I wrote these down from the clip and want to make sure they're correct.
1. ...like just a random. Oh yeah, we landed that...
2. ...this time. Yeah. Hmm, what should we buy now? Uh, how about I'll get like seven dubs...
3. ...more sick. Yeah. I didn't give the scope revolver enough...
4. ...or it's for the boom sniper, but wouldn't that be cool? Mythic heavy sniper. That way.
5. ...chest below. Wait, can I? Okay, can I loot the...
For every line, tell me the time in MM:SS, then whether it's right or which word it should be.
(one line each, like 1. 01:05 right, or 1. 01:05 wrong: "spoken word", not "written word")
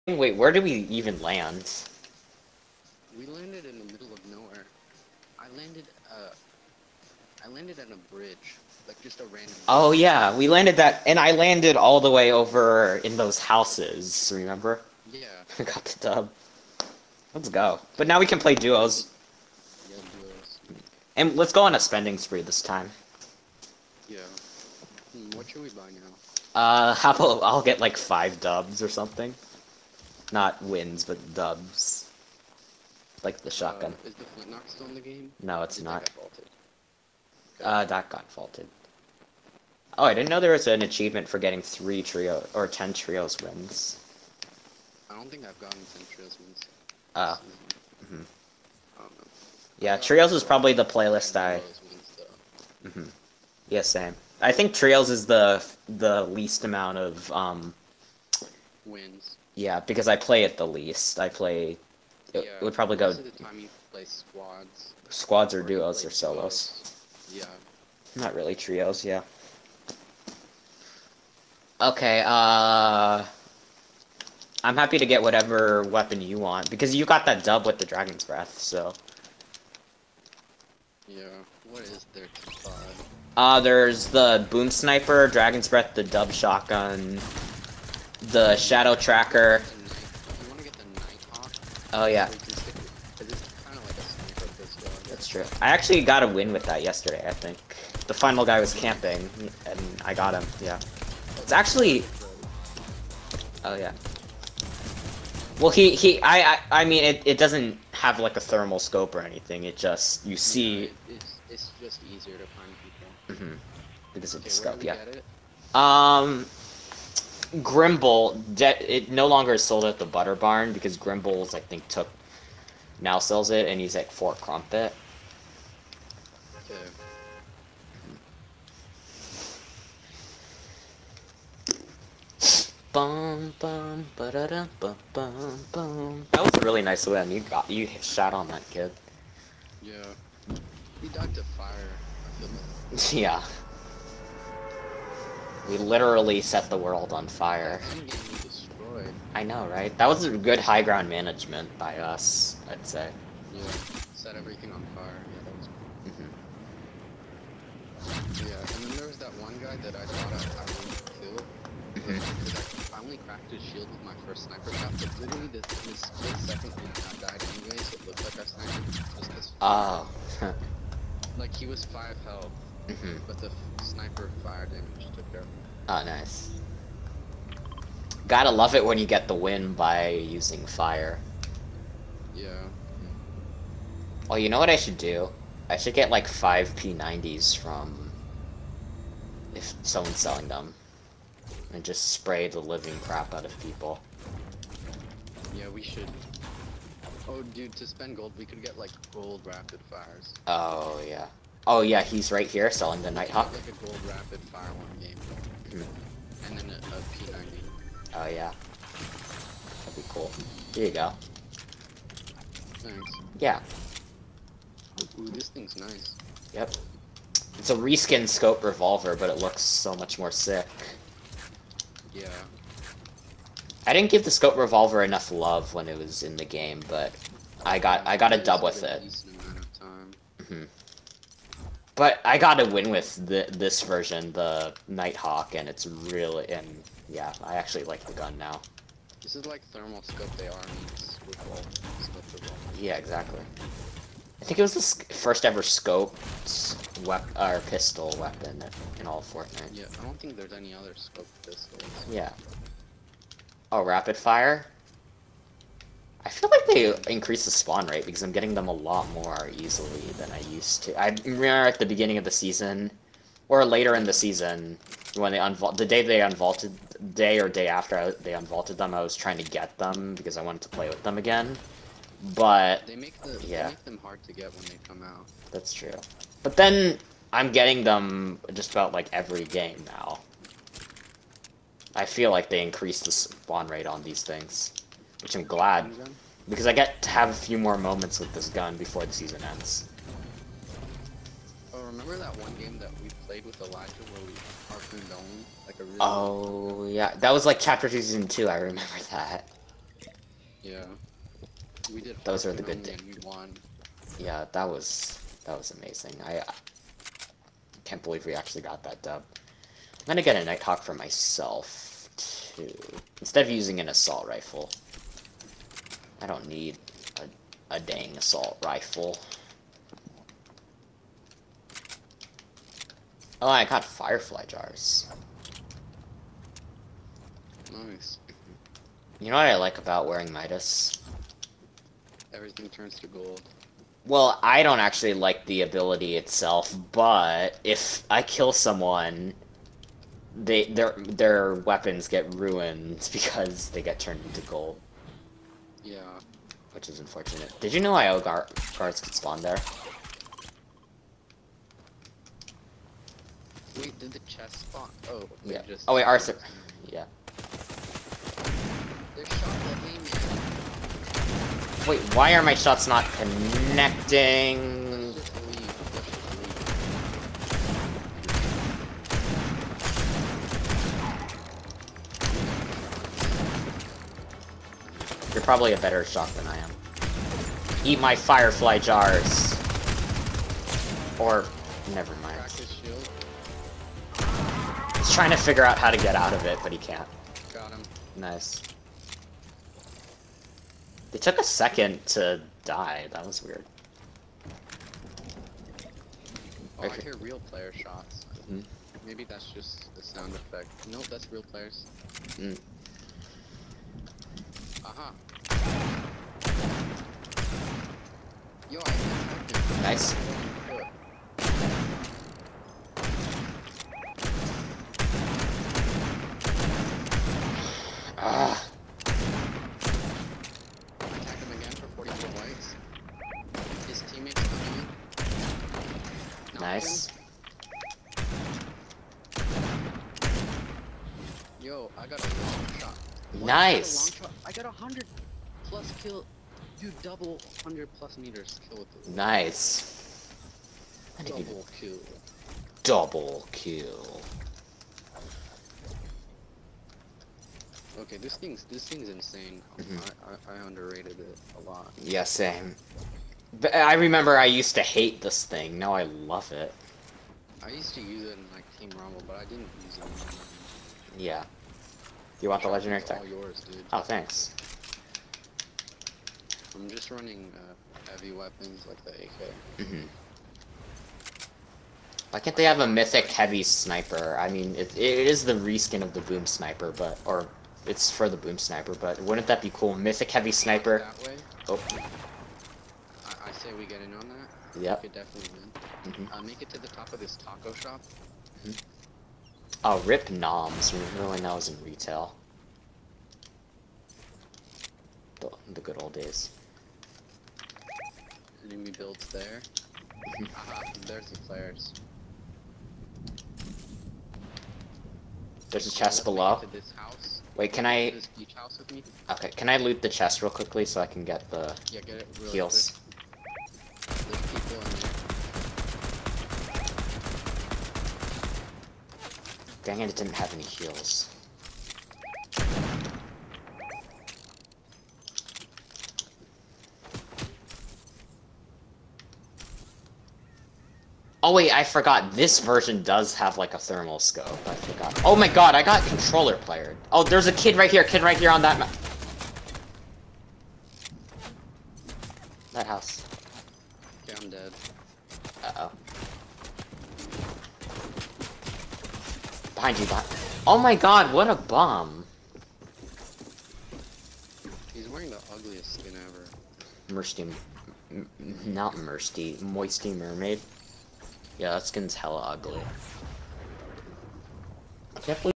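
1. 00:08 right
2. 00:22 wrong: "five", not "seven"
3. 03:40 right
4. 07:57 right
5. 08:25 right.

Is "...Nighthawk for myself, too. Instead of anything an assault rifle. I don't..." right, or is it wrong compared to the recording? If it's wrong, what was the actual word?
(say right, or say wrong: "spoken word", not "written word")
wrong: "using", not "anything".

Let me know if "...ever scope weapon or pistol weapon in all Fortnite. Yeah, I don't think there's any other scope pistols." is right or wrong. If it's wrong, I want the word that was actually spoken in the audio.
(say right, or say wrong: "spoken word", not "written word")
right.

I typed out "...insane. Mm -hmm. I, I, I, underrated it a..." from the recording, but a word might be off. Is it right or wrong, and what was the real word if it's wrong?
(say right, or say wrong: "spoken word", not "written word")
right.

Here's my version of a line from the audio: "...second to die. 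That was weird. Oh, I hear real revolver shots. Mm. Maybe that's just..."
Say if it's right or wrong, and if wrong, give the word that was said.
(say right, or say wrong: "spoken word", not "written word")
wrong: "player", not "revolver".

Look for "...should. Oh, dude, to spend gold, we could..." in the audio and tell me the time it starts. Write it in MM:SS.
03:15.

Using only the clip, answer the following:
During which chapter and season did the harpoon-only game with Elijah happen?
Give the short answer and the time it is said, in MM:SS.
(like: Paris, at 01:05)
Chapter 2, Season 2, at 04:57.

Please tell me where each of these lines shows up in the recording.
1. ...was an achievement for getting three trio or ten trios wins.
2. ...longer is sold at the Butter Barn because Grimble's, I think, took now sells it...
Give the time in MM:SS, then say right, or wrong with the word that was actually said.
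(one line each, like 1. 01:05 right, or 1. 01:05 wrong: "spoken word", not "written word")
1. 00:40 right
2. 01:59 right.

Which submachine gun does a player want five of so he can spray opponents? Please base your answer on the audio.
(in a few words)
P90.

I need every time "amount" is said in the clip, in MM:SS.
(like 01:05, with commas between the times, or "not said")
00:56.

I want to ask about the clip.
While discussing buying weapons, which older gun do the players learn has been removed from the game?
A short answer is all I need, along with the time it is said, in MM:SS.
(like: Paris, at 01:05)
flintlock, at 00:34.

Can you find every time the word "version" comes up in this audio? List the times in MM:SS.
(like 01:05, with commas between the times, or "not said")
03:53, 08:52.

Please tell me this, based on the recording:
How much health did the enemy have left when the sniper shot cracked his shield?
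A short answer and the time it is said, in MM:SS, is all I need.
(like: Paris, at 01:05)
5, at 02:51.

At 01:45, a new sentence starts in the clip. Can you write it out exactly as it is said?
Well, he, he, I, I, I mean, it, it doesn't have like a thermal scope or anything.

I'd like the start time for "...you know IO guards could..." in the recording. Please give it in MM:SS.
05:47.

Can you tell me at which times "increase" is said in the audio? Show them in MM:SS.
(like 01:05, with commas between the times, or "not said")
04:17, 04:42.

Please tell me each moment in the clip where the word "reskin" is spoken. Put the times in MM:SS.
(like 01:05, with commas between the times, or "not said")
03:37, 07:55.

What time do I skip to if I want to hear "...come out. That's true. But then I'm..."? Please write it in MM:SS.
04:34.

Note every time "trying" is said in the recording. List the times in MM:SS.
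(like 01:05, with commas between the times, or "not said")
04:29, 06:25.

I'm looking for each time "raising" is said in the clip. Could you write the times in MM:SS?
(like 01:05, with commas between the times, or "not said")
not said.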